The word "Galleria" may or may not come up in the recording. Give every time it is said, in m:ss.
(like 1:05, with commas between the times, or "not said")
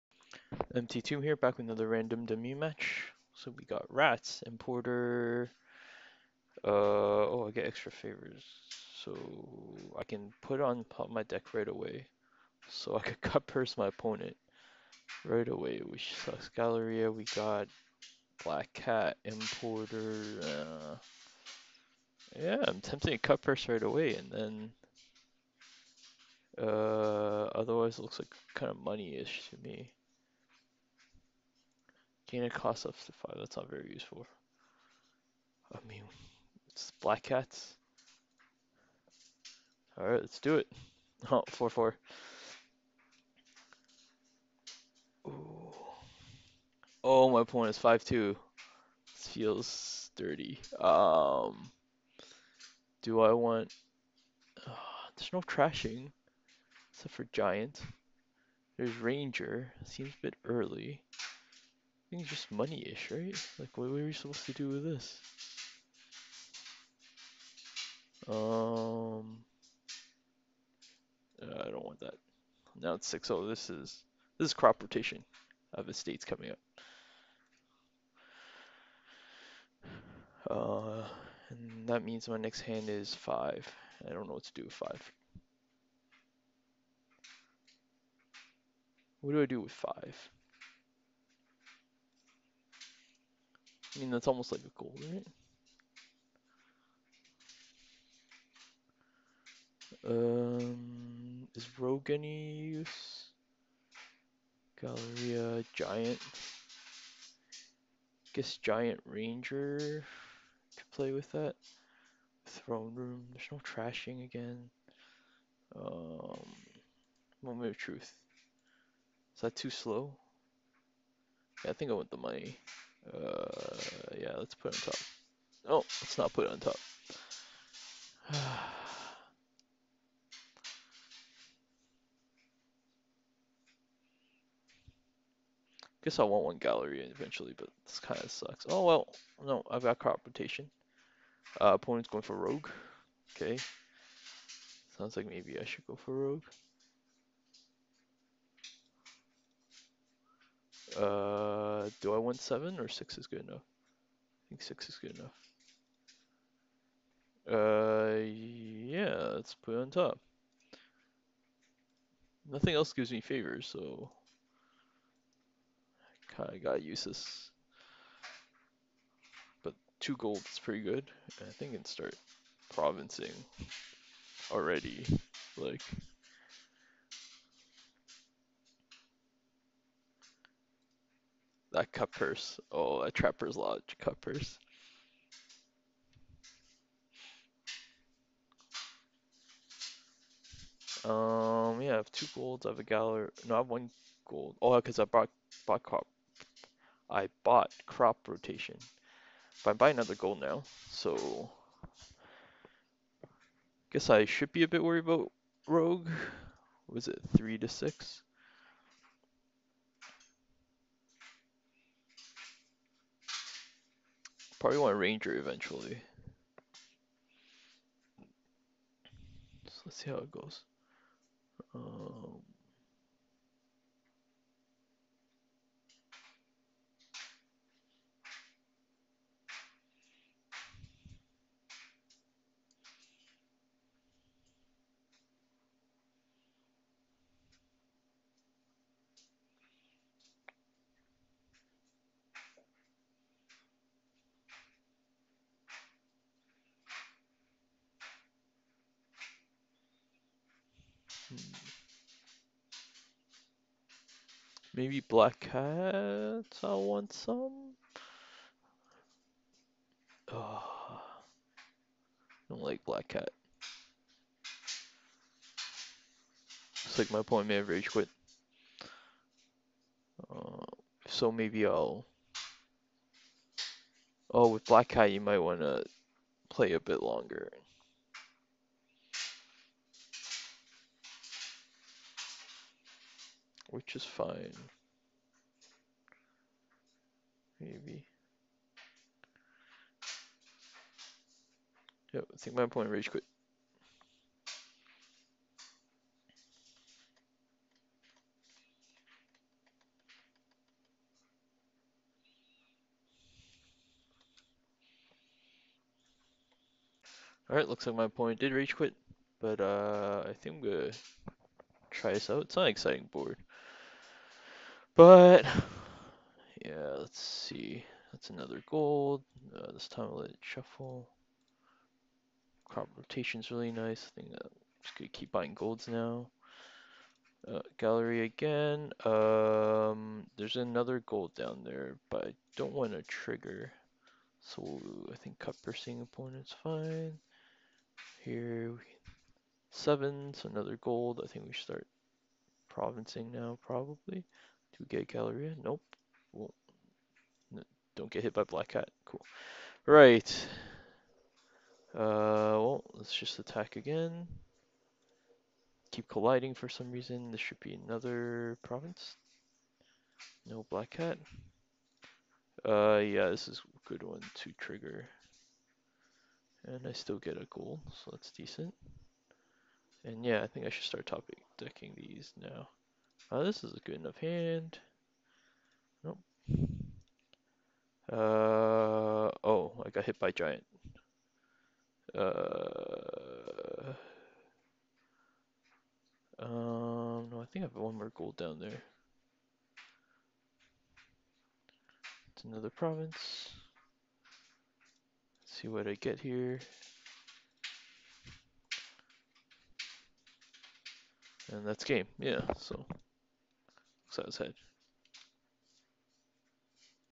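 0:16, 1:44, 2:16, 3:12, 5:27, 5:45.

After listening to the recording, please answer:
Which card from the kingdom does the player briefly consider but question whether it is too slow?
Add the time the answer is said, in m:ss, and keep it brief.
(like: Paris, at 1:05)
Moment of Truth, at 1:57.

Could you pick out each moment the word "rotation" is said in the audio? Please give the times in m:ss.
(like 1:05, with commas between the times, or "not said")
1:14, 2:20, 3:18, 5:22.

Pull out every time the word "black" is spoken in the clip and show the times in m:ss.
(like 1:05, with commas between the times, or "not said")
0:18, 0:37, 4:14, 4:22, 4:34, 5:48, 6:00.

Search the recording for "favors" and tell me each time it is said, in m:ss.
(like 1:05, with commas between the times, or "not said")
0:07, 2:43.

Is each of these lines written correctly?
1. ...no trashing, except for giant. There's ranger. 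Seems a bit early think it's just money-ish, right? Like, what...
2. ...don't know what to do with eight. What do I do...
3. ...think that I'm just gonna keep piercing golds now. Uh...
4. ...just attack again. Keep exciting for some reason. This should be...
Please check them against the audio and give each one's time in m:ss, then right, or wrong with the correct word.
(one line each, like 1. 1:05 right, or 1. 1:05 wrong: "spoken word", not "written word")
1. 0:55 right
2. 1:24 wrong: "five", not "eight"
3. 5:24 wrong: "buying", not "piercing"
4. 5:53 wrong: "colliding", not "exciting".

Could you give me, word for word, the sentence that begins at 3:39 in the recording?
So let's see how it goes.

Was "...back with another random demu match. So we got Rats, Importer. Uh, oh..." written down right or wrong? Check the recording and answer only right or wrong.
right.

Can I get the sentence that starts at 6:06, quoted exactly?
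And I still get a gold, so that's decent.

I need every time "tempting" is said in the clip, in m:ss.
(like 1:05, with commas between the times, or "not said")
0:22.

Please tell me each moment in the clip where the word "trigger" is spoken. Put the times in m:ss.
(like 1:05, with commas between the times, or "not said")
5:33, 6:04.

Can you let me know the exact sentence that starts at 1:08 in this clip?
Um, uh, I don't want that.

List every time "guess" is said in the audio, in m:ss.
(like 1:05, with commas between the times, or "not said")
1:48, 2:16, 3:23.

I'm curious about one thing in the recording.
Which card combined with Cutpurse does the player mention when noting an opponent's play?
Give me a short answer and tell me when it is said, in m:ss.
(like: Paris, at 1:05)
Trapper's Lodge, at 3:03.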